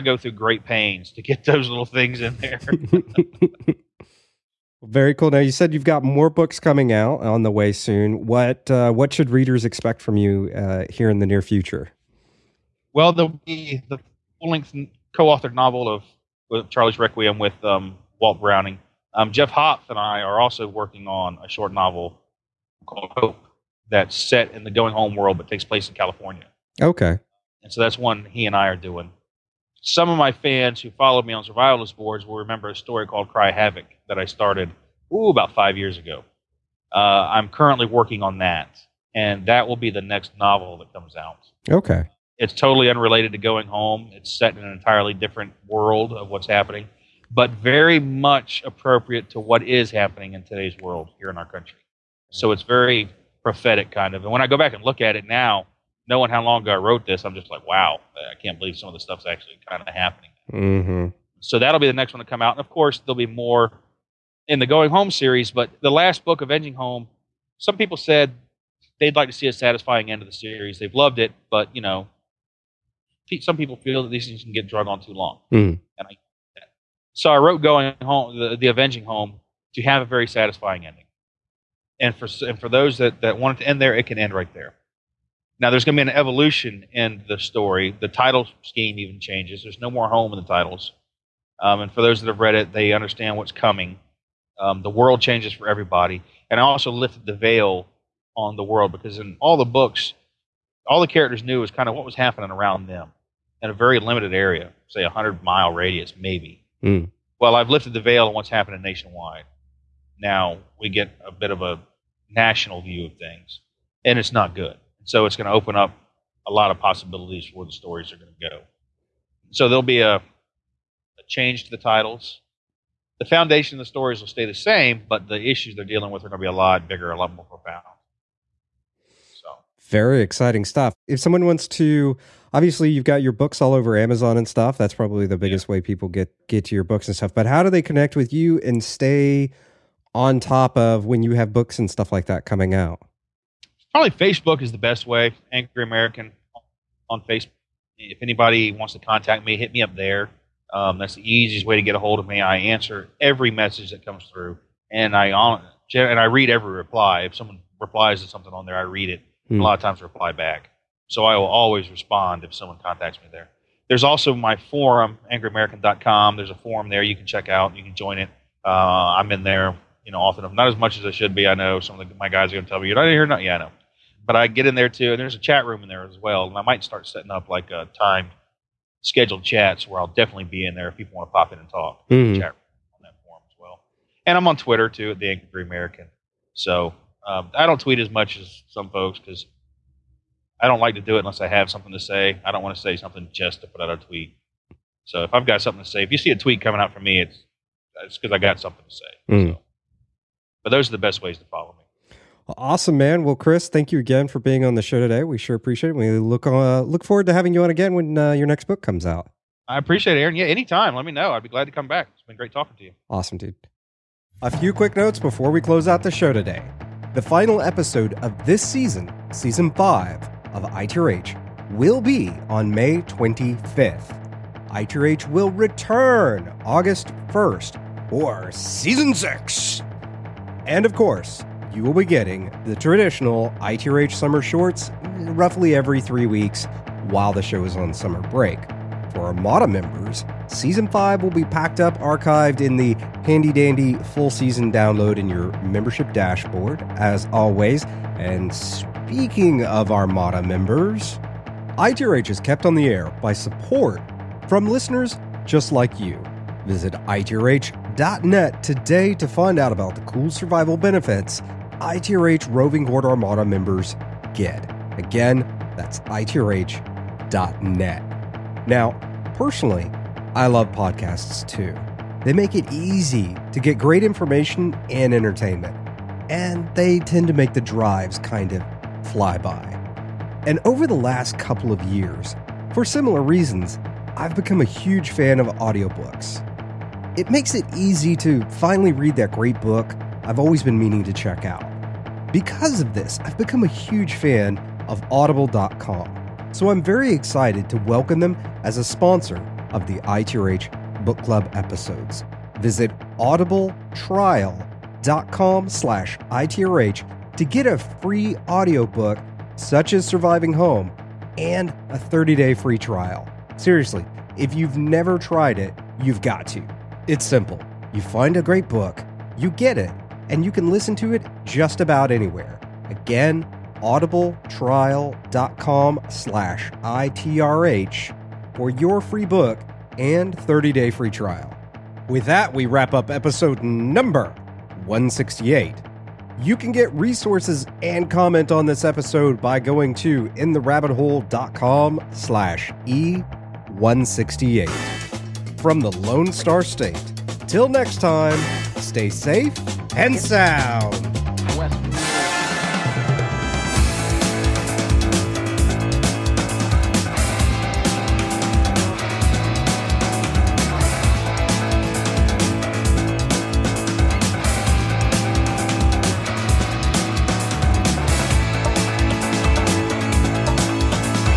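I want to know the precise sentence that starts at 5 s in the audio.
Now you said you've got more books coming out on the way soon.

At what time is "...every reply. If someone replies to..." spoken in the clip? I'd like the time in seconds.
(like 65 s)
156 s.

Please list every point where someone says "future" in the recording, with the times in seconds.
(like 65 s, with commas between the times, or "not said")
11 s.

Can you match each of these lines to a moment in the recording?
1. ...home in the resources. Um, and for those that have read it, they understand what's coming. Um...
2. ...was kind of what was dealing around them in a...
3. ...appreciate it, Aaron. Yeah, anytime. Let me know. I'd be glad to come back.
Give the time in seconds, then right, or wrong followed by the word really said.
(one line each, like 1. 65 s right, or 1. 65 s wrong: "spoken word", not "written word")
1. 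90 s wrong: "titles", not "resources"
2. 101 s wrong: "happening", not "dealing"
3. 209 s right.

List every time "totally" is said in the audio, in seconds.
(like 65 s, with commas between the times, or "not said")
42 s.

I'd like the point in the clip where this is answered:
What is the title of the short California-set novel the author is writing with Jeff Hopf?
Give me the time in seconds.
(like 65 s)
23 s.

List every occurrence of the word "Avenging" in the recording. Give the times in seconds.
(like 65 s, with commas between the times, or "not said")
66 s, 78 s.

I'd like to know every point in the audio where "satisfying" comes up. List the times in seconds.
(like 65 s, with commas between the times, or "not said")
69 s, 80 s.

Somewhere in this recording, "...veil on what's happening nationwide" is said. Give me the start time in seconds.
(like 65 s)
108 s.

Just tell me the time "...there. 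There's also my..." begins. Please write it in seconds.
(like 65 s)
163 s.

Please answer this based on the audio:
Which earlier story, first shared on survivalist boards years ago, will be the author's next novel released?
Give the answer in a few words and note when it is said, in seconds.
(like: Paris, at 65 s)
Cry Havoc, at 33 s.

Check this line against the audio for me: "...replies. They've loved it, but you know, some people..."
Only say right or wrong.
wrong.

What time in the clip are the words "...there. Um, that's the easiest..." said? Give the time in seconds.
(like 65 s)
149 s.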